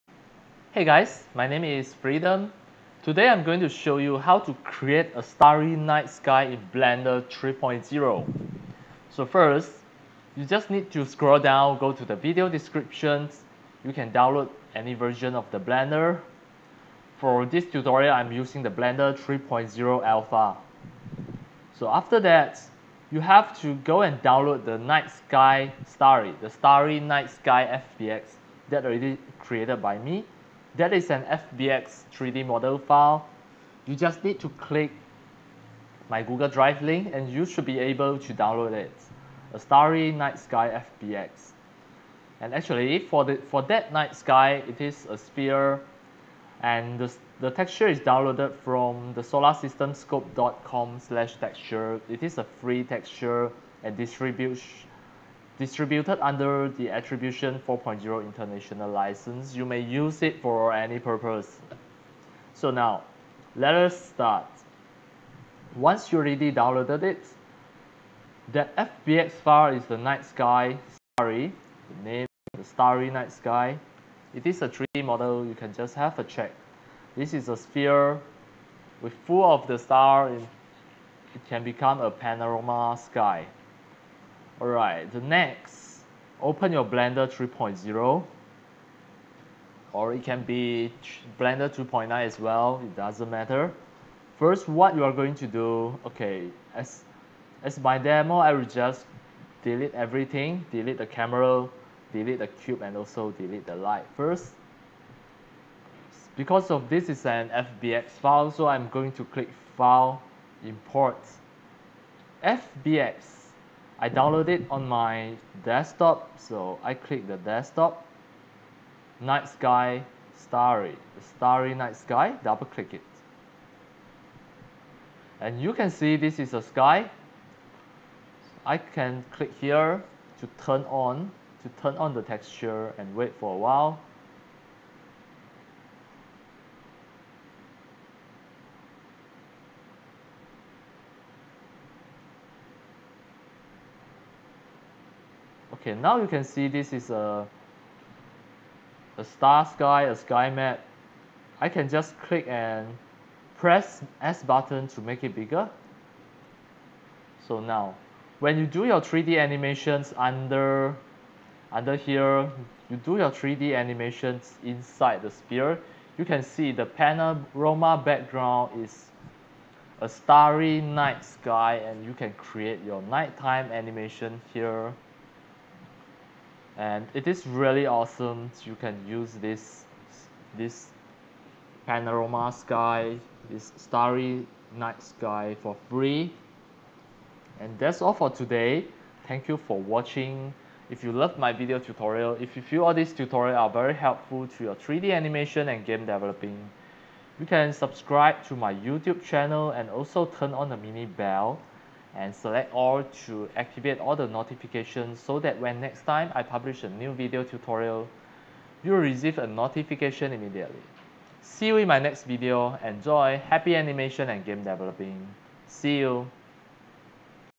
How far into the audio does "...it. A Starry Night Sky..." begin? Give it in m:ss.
0:38.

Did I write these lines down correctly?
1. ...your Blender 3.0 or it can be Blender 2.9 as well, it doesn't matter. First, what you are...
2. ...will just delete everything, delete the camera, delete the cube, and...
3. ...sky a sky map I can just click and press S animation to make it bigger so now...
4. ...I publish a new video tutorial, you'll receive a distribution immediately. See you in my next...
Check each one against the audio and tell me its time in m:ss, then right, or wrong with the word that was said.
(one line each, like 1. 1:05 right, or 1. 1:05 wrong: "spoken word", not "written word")
1. 1:26 right
2. 1:38 right
3. 2:29 wrong: "button", not "animation"
4. 3:26 wrong: "notification", not "distribution".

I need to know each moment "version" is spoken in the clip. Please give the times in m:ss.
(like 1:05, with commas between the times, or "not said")
0:14.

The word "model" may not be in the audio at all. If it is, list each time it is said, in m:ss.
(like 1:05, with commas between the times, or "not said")
0:32, 1:15.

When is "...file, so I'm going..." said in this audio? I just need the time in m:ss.
1:48.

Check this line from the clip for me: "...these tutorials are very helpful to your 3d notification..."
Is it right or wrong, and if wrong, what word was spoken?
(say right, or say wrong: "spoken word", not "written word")
wrong: "animation", not "notification".